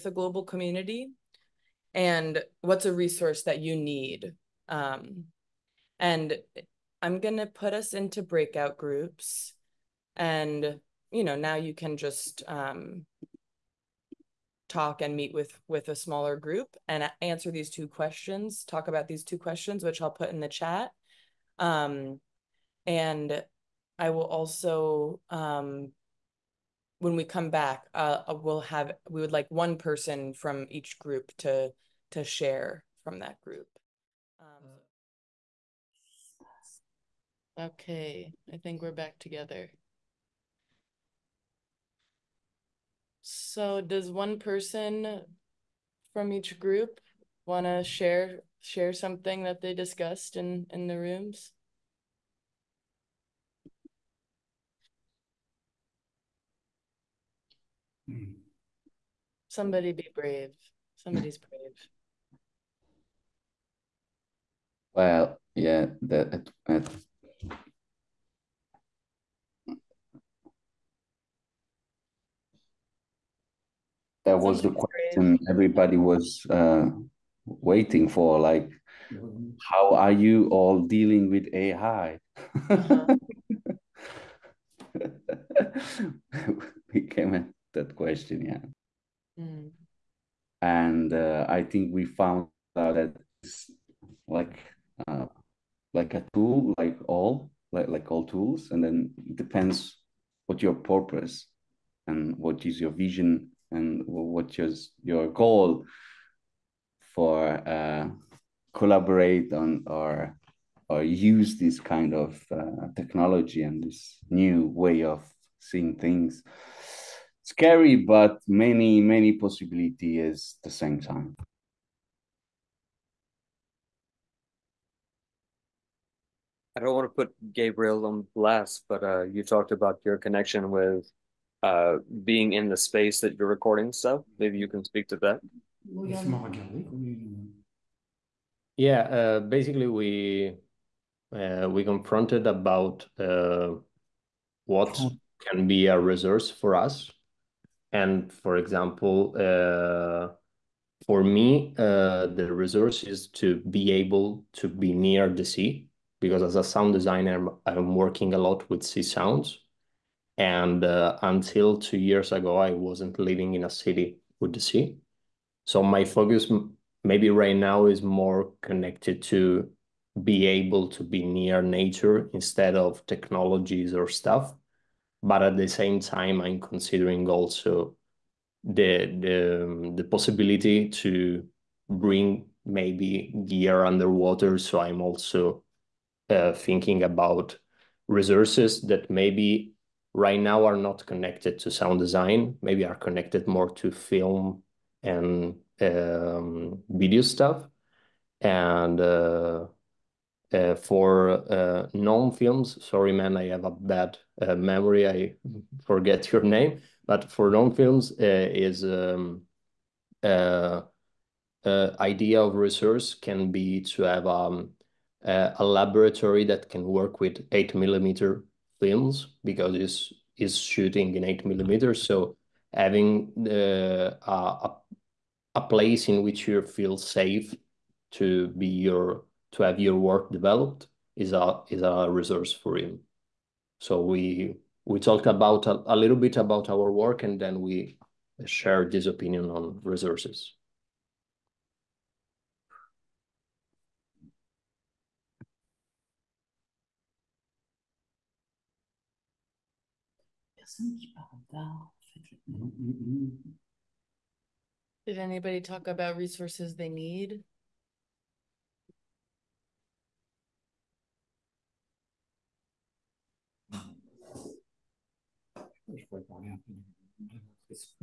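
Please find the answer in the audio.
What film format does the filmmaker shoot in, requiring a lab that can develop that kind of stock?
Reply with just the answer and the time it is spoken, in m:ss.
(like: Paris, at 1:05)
8 millimeter, at 3:37.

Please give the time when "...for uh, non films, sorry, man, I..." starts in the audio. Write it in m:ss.
3:20.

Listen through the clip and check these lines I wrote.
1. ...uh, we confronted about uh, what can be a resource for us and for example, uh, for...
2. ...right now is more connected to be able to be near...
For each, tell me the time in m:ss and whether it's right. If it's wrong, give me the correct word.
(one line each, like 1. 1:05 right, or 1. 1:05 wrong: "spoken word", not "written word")
1. 2:21 right
2. 2:47 right.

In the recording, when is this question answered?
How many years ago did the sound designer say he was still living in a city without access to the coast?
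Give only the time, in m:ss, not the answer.
2:41.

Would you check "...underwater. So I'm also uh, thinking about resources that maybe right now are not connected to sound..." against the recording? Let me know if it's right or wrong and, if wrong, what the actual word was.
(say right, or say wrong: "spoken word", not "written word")
right.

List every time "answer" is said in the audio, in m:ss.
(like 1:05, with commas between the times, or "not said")
0:17.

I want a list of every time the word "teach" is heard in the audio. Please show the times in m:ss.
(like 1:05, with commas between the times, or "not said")
not said.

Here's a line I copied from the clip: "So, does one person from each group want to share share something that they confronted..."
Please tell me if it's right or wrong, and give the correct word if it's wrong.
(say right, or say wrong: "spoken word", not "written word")
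wrong: "discussed", not "confronted".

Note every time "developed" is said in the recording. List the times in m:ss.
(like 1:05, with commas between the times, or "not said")
3:50.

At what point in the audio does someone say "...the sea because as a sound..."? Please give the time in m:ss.
2:35.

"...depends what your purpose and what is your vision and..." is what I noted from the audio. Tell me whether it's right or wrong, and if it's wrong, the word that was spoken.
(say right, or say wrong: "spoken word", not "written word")
right.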